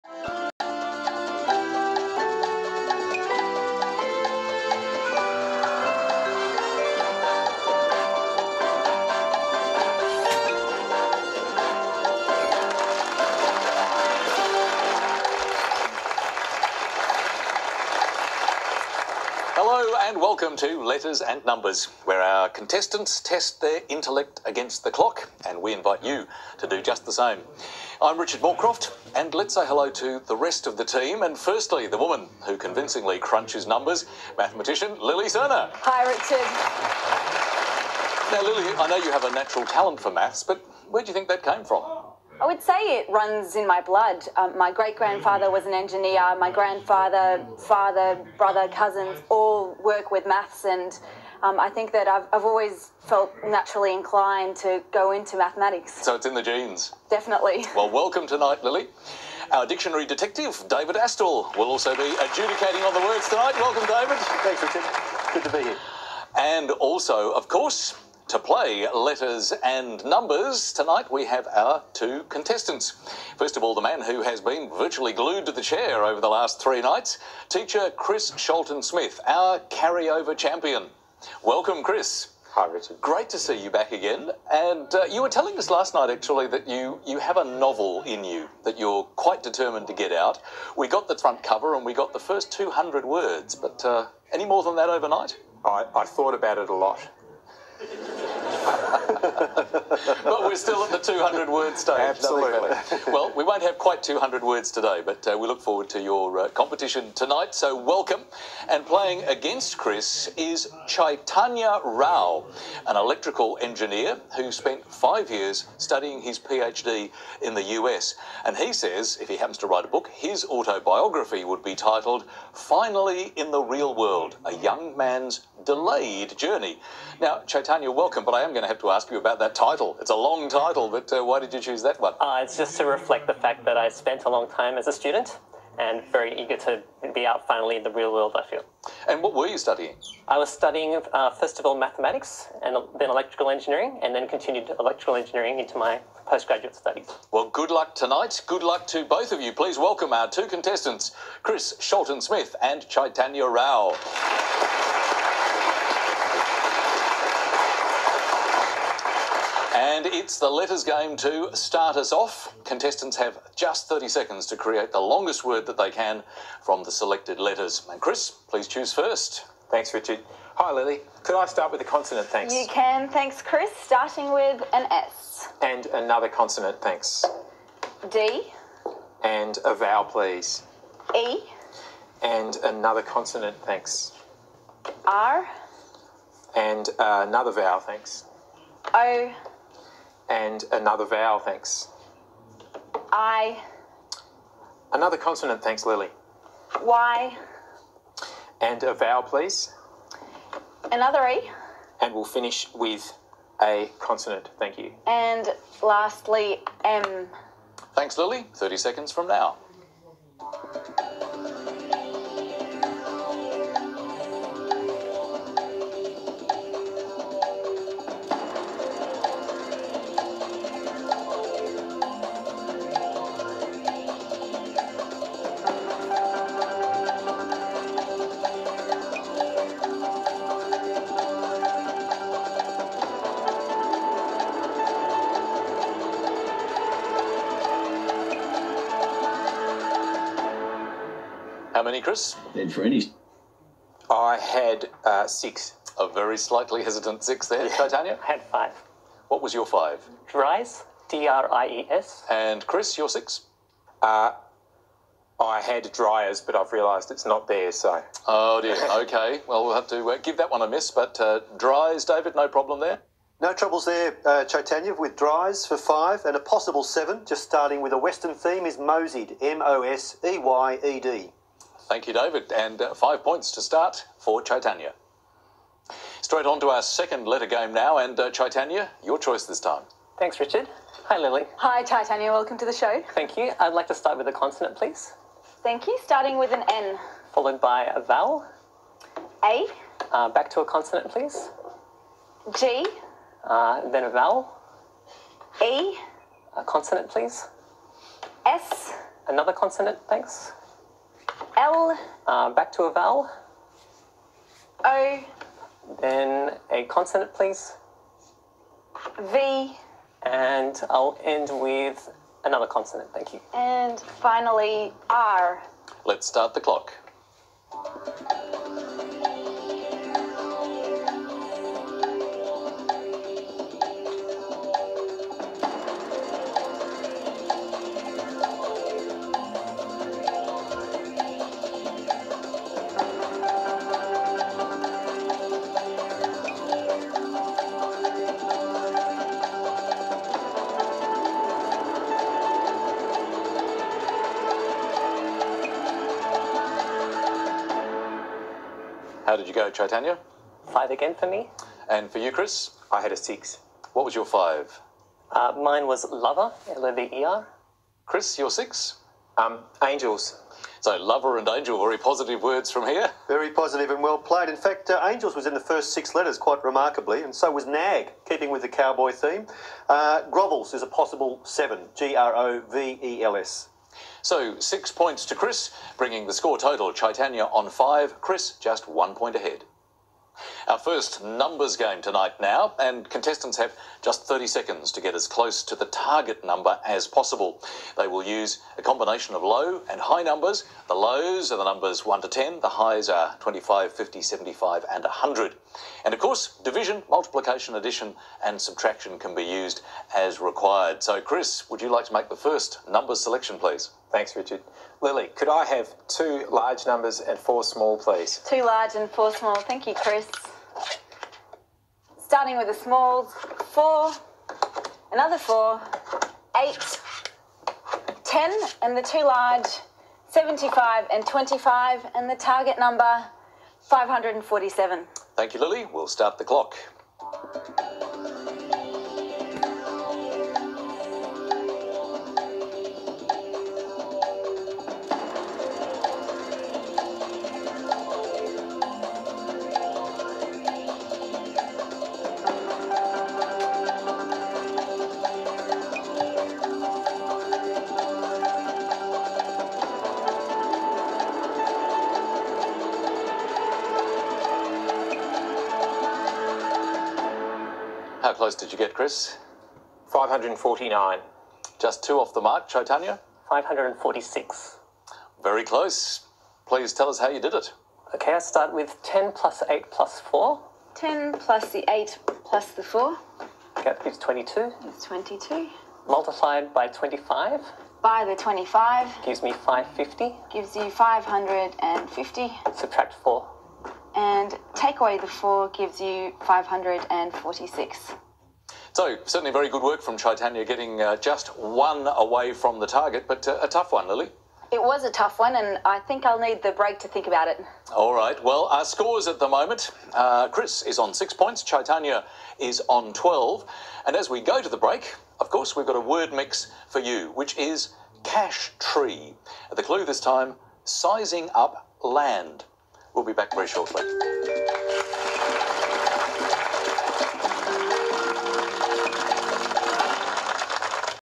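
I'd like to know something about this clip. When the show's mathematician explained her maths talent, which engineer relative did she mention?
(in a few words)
Great grandfather.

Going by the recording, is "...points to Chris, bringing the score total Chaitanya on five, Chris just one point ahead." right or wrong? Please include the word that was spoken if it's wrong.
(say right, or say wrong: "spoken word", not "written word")
right.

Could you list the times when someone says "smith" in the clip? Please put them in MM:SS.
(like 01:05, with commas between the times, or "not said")
01:18, 02:32.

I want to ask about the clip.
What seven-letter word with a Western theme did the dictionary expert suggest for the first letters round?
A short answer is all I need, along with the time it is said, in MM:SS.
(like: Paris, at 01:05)
Moseyed, at 04:28.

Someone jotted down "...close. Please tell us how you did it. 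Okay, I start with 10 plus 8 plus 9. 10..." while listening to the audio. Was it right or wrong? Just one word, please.
wrong.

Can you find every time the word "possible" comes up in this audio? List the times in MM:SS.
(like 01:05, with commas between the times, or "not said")
04:26, 06:10, 06:27.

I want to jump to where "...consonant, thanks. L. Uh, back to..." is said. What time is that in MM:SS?
04:59.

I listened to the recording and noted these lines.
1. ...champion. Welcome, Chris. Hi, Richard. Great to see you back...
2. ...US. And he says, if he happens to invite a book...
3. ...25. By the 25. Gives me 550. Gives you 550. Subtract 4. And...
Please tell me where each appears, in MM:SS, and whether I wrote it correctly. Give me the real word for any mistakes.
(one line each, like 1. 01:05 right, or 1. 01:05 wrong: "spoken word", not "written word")
1. 01:20 right
2. 01:57 wrong: "write", not "invite"
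3. 07:56 right.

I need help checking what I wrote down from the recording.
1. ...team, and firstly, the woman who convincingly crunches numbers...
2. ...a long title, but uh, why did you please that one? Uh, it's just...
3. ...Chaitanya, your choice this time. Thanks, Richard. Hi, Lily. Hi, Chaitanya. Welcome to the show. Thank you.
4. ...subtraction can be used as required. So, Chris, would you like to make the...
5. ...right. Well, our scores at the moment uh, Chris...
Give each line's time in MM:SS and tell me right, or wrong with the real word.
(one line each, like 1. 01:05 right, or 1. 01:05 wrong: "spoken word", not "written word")
1. 00:30 right
2. 02:10 wrong: "choose", not "please"
3. 04:38 right
4. 06:38 right
5. 08:18 right.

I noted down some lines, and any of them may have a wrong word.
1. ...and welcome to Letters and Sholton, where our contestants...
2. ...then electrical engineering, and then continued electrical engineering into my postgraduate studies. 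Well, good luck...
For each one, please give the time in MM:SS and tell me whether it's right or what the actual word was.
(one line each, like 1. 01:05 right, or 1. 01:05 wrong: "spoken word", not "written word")
1. 00:20 wrong: "Numbers", not "Sholton"
2. 02:22 right.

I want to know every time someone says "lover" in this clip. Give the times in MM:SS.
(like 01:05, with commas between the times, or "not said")
05:56, 06:00.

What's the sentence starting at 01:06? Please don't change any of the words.
And also, of course, to play letters and numbers, tonight we have our two contestants.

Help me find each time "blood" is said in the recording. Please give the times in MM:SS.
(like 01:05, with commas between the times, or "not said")
00:43.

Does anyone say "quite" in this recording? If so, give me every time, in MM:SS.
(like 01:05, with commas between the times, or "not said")
01:29, 01:43, 06:06.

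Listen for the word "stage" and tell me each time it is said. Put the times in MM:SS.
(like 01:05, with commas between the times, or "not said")
01:41.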